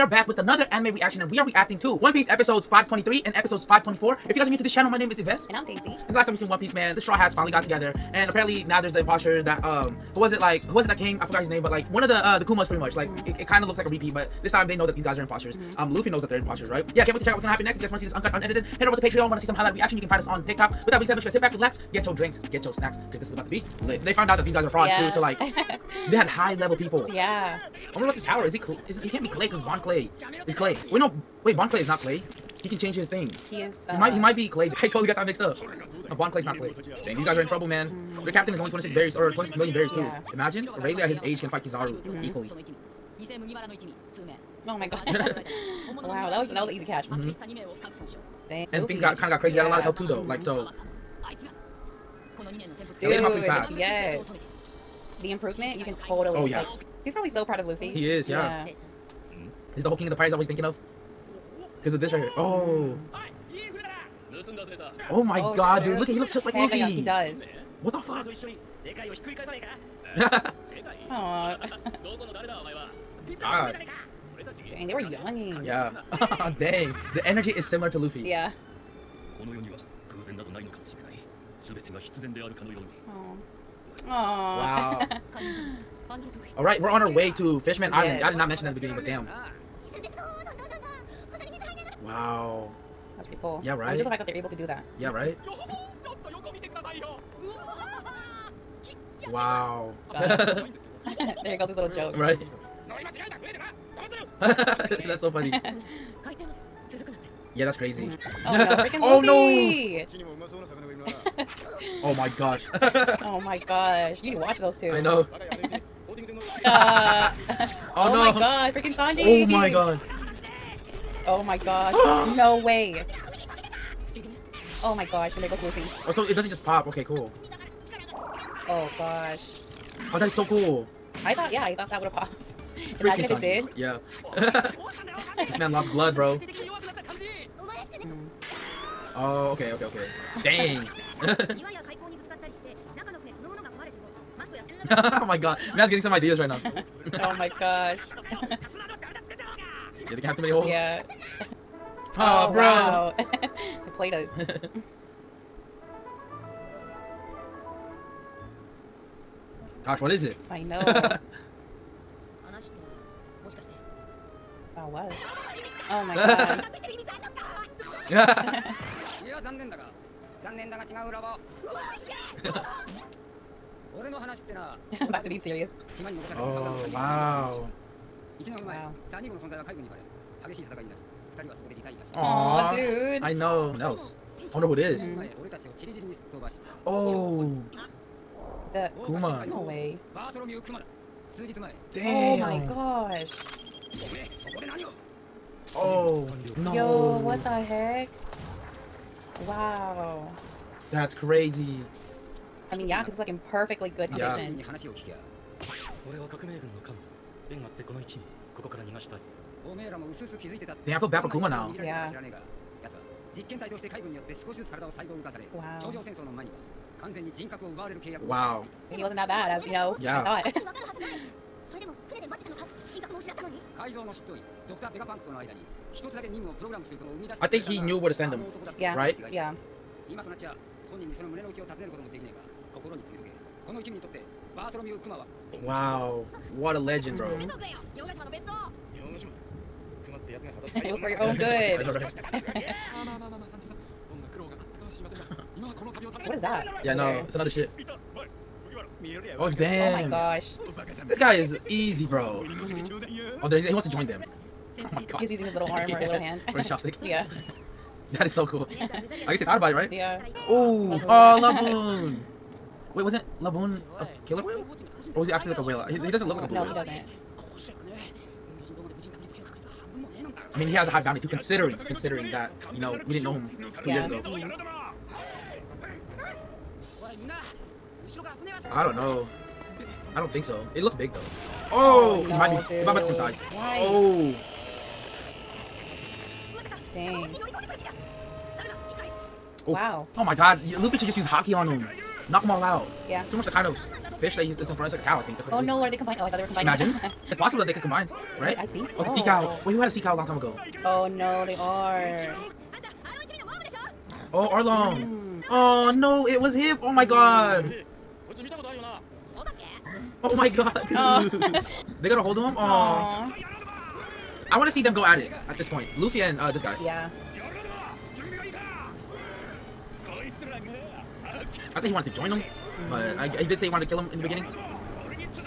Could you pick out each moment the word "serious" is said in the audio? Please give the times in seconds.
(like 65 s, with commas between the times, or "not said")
175 s.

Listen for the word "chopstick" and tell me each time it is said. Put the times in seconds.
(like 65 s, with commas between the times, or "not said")
256 s.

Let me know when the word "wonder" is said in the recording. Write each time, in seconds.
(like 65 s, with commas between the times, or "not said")
27 s, 184 s.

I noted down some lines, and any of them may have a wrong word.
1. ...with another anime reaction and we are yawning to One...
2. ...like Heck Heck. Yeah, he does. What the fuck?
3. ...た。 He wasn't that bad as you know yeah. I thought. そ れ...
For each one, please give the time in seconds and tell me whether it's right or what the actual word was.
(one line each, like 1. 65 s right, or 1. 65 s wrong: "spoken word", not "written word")
1. 0 s wrong: "reacting", not "yawning"
2. 66 s wrong: "Luffy", not "Heck"
3. 218 s right.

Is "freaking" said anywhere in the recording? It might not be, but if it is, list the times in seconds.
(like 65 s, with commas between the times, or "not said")
108 s, 118 s.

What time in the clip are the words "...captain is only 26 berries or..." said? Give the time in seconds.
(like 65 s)
38 s.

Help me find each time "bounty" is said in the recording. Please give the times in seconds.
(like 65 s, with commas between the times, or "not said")
270 s.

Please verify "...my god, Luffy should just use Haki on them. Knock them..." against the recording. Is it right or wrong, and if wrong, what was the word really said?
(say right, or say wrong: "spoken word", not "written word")
right.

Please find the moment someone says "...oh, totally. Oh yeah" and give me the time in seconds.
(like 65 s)
55 s.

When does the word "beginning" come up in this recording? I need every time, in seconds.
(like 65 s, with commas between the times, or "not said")
88 s, 324 s.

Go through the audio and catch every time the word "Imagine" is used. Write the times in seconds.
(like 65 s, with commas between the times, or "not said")
40 s, 133 s, 296 s.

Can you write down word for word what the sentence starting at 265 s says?
He, he doesn't look like a blue no, whale.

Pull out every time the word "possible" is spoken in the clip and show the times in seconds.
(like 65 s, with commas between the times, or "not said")
297 s.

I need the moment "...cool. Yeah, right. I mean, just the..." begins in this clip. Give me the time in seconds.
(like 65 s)
93 s.